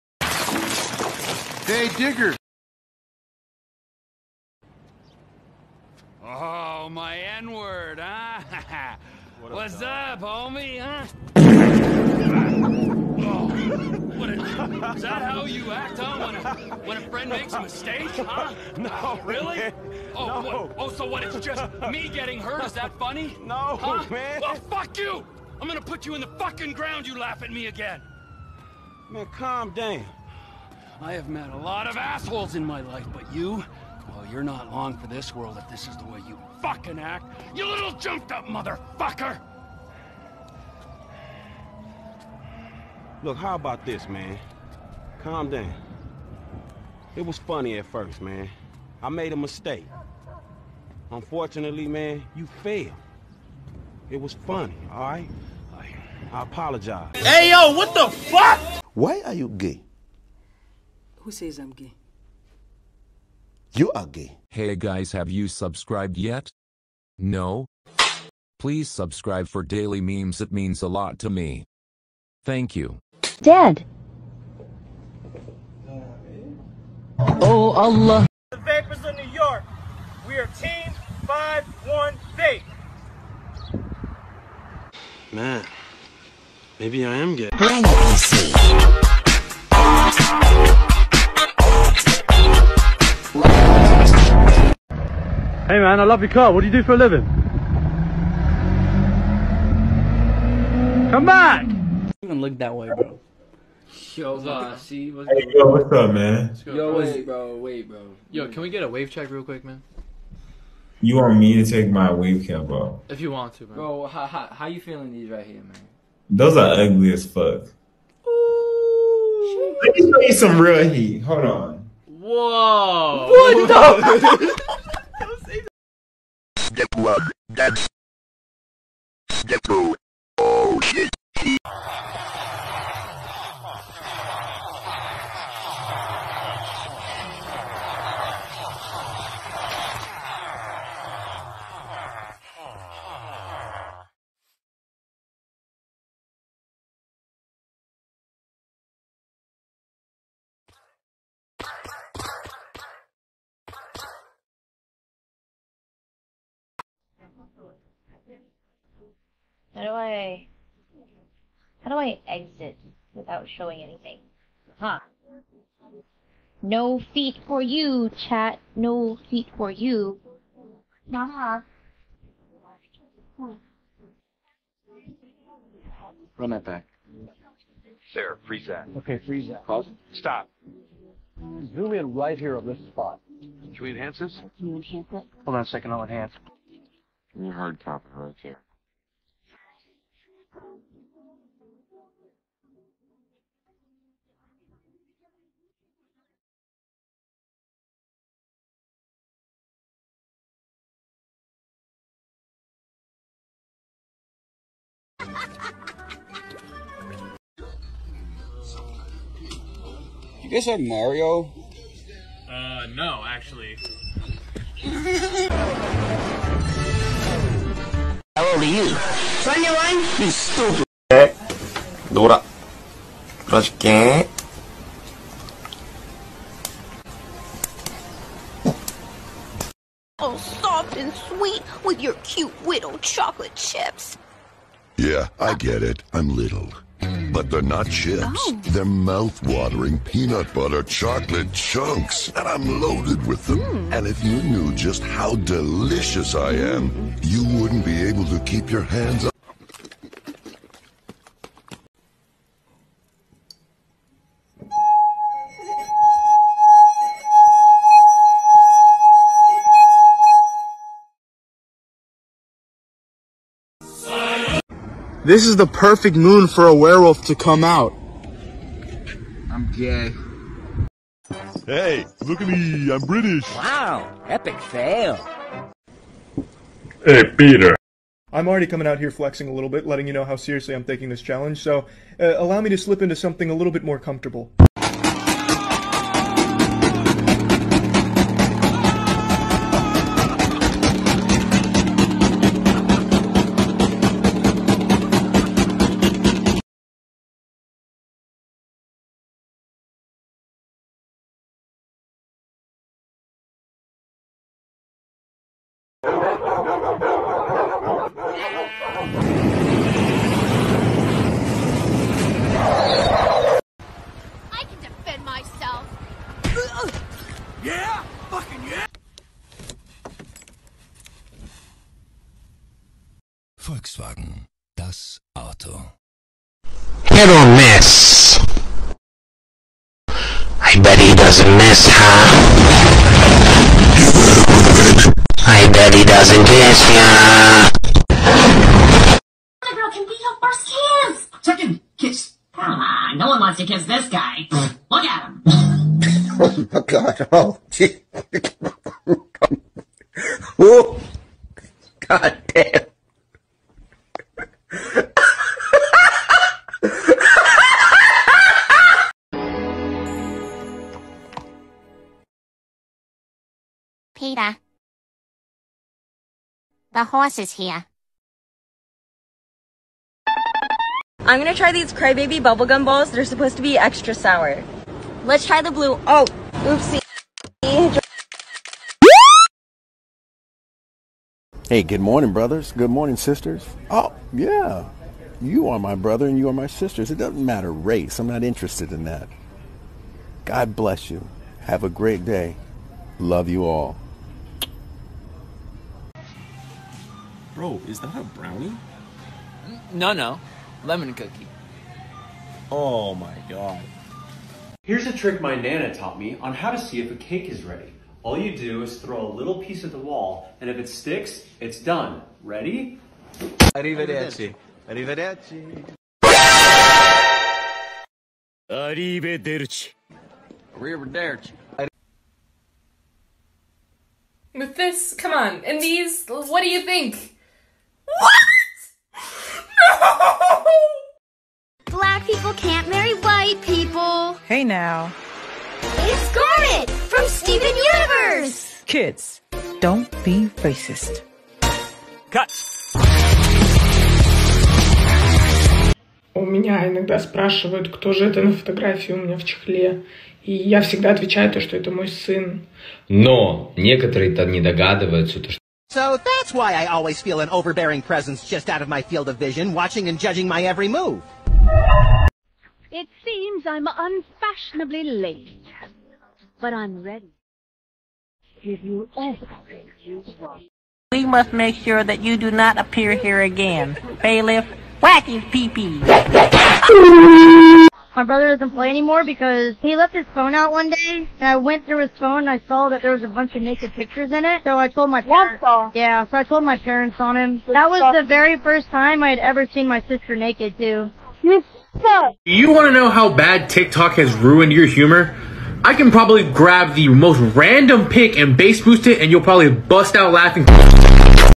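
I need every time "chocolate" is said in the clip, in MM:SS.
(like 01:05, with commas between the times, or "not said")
03:52, 04:00.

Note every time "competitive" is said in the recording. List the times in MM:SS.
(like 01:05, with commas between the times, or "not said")
not said.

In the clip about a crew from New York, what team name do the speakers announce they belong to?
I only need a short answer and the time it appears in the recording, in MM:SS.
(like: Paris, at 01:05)
Team 518, at 01:20.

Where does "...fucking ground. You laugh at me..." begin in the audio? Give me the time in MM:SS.
00:26.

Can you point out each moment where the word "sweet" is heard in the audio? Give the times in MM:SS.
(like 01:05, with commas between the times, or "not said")
03:51.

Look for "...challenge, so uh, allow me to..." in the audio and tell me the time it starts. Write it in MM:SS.
04:41.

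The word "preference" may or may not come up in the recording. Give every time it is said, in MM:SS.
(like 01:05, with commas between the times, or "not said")
not said.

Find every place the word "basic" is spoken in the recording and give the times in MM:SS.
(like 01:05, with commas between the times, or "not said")
not said.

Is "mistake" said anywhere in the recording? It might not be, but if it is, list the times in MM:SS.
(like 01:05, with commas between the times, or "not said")
00:17, 00:49.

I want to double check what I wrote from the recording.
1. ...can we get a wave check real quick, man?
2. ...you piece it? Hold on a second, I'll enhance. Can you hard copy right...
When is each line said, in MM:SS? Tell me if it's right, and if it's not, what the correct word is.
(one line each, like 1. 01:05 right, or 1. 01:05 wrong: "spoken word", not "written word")
1. 01:48 right
2. 03:04 wrong: "enhance", not "piece".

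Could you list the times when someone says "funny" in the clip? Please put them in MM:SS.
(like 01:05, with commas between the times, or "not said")
00:22, 00:47, 00:54.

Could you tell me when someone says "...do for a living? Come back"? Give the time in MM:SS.
01:36.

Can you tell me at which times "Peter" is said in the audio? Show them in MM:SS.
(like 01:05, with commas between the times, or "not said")
04:37, 06:04.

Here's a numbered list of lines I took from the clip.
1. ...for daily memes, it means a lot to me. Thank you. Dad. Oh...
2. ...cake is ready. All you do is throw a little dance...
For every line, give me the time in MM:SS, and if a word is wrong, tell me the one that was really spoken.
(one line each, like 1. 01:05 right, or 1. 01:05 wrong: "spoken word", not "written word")
1. 01:09 right
2. 06:47 wrong: "piece", not "dance".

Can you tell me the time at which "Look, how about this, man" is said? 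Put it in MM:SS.
00:43.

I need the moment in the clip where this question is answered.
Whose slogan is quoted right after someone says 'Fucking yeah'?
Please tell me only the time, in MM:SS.
05:23.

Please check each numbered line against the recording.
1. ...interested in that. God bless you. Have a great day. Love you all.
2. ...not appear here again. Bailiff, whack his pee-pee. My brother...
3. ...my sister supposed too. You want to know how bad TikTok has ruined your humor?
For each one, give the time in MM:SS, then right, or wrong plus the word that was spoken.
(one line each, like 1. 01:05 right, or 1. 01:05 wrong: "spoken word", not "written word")
1. 06:28 right
2. 07:52 right
3. 08:09 wrong: "naked", not "supposed".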